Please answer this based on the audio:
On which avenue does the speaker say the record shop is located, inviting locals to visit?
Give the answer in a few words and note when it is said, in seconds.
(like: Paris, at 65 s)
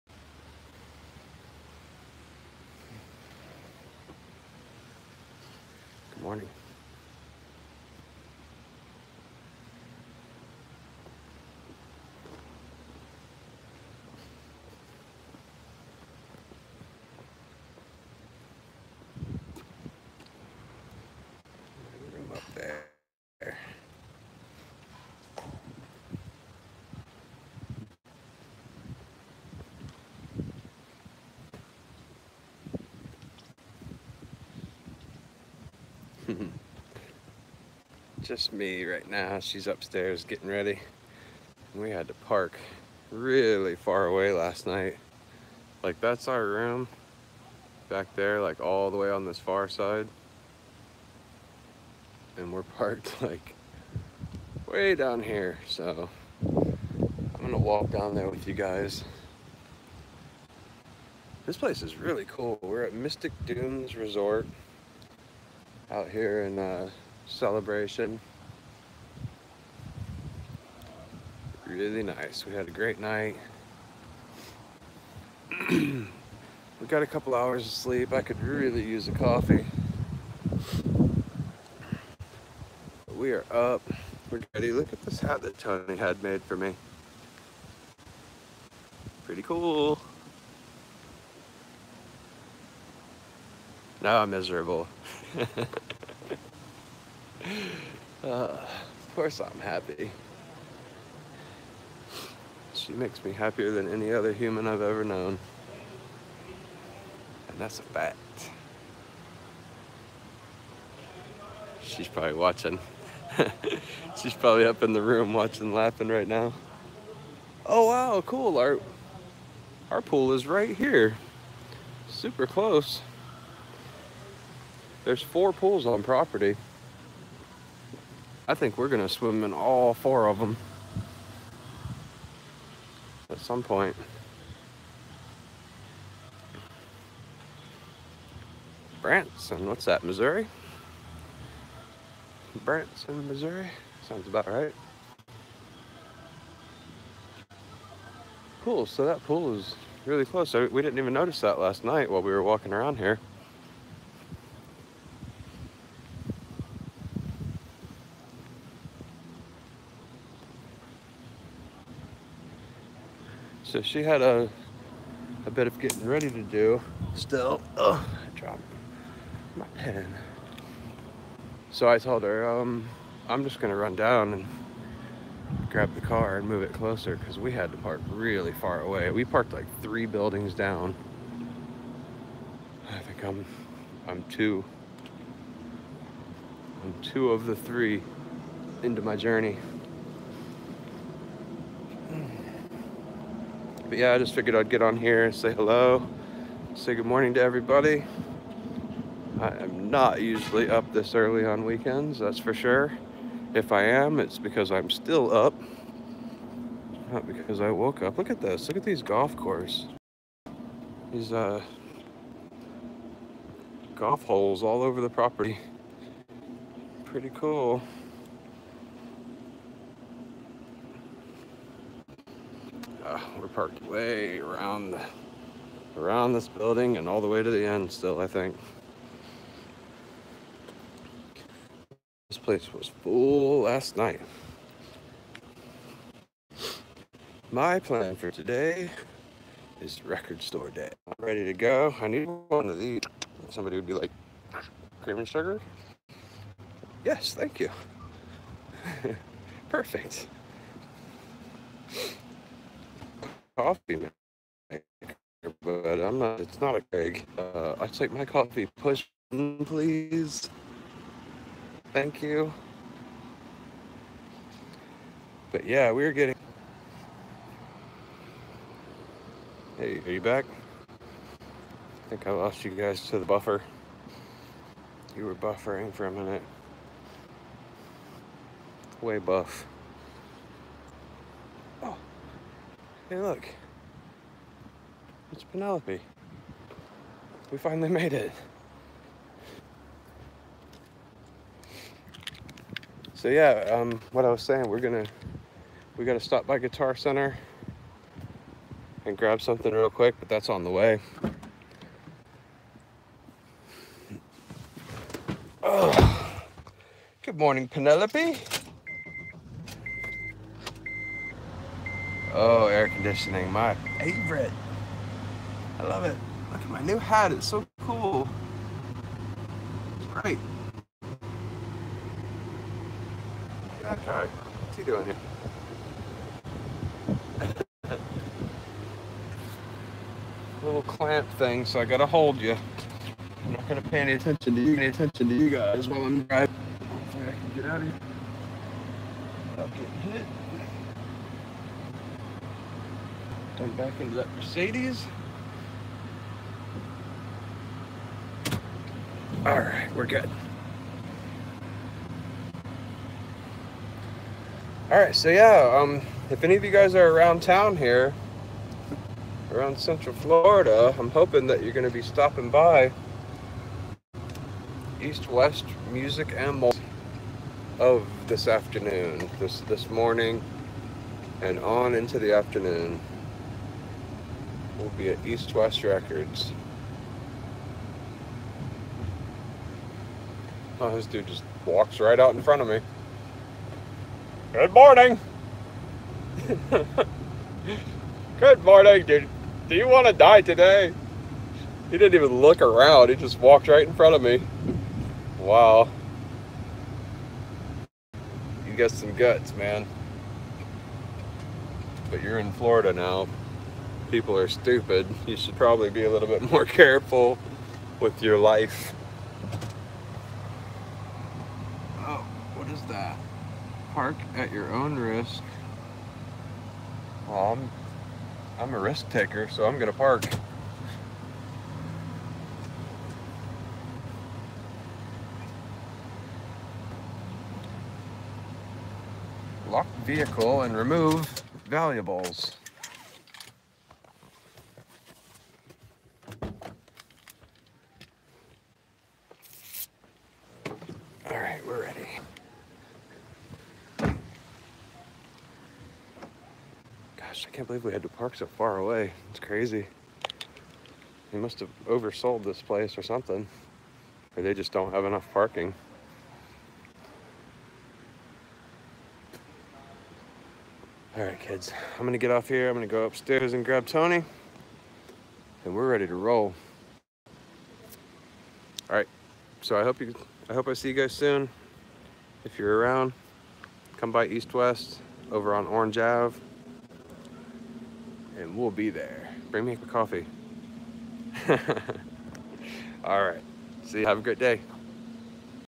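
Orange Ave, at 475 s.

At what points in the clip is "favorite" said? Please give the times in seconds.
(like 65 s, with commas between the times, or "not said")
313 s.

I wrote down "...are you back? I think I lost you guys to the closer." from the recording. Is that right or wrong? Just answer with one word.
wrong.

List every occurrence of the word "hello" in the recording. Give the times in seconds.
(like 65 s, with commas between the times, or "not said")
195 s.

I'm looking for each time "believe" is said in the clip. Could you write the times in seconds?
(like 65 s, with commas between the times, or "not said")
447 s.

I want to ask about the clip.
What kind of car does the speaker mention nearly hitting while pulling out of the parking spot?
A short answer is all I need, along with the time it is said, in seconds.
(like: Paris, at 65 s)
Mercedes, at 344 s.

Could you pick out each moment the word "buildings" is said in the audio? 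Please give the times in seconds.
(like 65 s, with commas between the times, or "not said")
180 s, 226 s.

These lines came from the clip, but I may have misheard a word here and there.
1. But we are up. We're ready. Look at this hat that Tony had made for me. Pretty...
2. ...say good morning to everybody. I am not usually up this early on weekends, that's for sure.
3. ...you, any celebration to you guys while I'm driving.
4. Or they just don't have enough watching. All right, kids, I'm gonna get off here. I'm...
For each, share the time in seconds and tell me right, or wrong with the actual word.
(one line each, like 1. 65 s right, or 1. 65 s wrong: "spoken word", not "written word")
1. 83 s right
2. 196 s right
3. 334 s wrong: "attention", not "celebration"
4. 454 s wrong: "parking", not "watching".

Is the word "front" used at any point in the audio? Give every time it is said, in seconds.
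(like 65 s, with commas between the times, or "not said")
382 s, 393 s.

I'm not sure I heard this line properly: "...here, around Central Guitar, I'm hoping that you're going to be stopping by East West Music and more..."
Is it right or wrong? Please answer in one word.
wrong.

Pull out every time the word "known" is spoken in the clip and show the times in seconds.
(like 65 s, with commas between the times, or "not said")
105 s.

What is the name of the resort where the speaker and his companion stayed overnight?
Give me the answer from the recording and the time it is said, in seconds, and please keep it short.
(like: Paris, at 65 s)
Mystic Dunes Resort, at 62 s.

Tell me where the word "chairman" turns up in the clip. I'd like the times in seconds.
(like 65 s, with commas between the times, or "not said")
not said.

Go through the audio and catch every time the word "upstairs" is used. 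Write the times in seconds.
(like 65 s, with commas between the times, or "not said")
39 s, 463 s.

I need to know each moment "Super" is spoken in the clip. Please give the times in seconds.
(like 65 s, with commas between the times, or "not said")
122 s.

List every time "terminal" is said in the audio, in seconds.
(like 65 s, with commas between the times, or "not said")
not said.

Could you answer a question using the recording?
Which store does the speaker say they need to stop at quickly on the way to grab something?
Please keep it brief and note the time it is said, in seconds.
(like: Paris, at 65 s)
Guitar Center, at 296 s.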